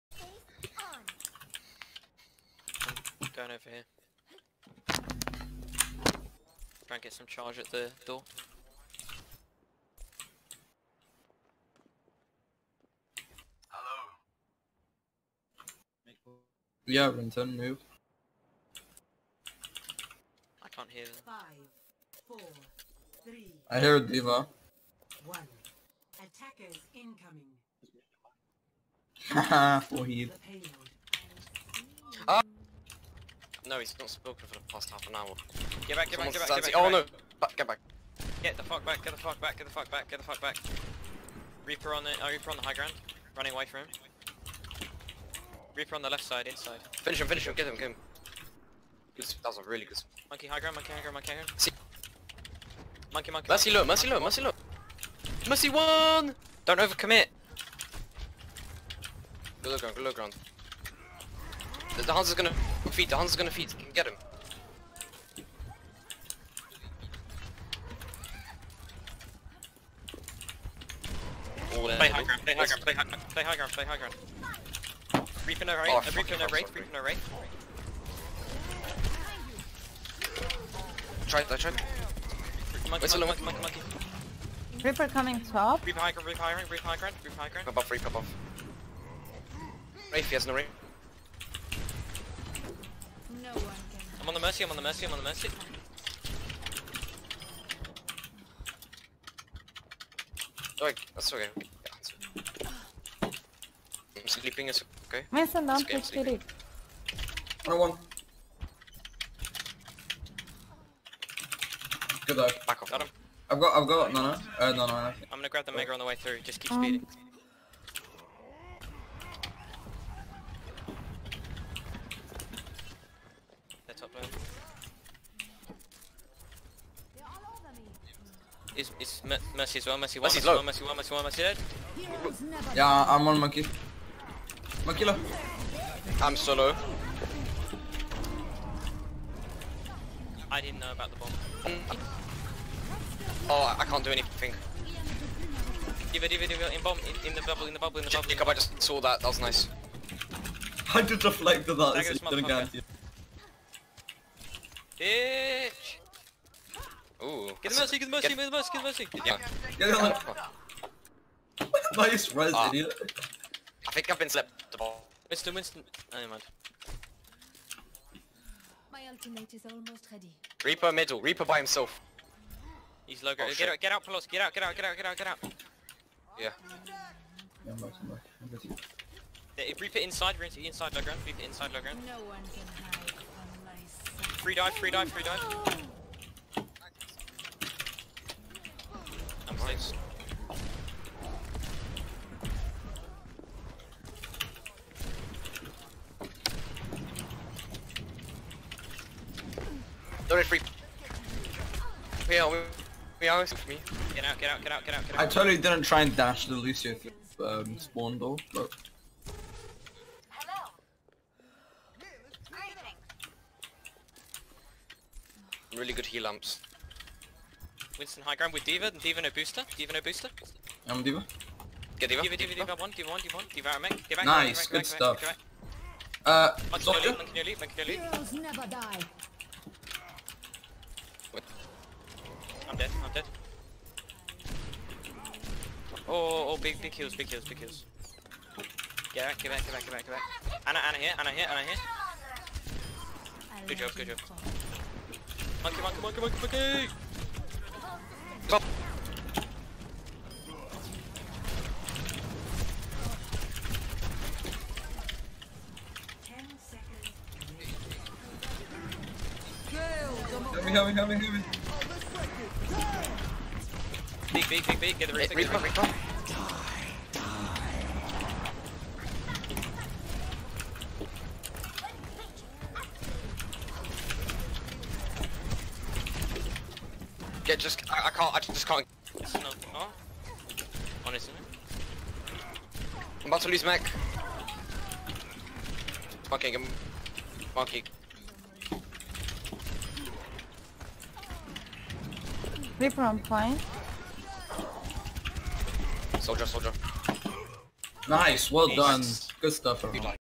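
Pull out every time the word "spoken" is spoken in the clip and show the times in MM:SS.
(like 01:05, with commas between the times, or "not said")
00:34.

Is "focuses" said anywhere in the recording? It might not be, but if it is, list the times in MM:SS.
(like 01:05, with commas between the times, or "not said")
not said.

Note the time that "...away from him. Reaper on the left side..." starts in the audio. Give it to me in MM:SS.
00:43.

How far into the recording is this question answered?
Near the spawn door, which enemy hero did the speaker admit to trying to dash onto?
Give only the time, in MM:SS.
03:26.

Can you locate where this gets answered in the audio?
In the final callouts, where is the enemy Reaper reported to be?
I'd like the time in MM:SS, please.
04:53.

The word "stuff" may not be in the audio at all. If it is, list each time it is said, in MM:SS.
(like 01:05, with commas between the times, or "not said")
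03:44, 04:59.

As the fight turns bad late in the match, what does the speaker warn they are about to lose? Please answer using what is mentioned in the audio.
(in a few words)
mech.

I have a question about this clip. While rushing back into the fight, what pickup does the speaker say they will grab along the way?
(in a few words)
mega.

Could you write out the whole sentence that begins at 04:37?
Yeah, just, I, I can't, I just can't.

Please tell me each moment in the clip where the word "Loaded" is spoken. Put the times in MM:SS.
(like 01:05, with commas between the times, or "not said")
03:20.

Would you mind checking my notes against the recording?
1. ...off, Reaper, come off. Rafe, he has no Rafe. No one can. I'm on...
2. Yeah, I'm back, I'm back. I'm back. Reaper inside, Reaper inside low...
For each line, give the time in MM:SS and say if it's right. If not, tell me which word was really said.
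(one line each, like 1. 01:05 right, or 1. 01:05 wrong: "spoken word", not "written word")
1. 01:27 right
2. 02:57 right.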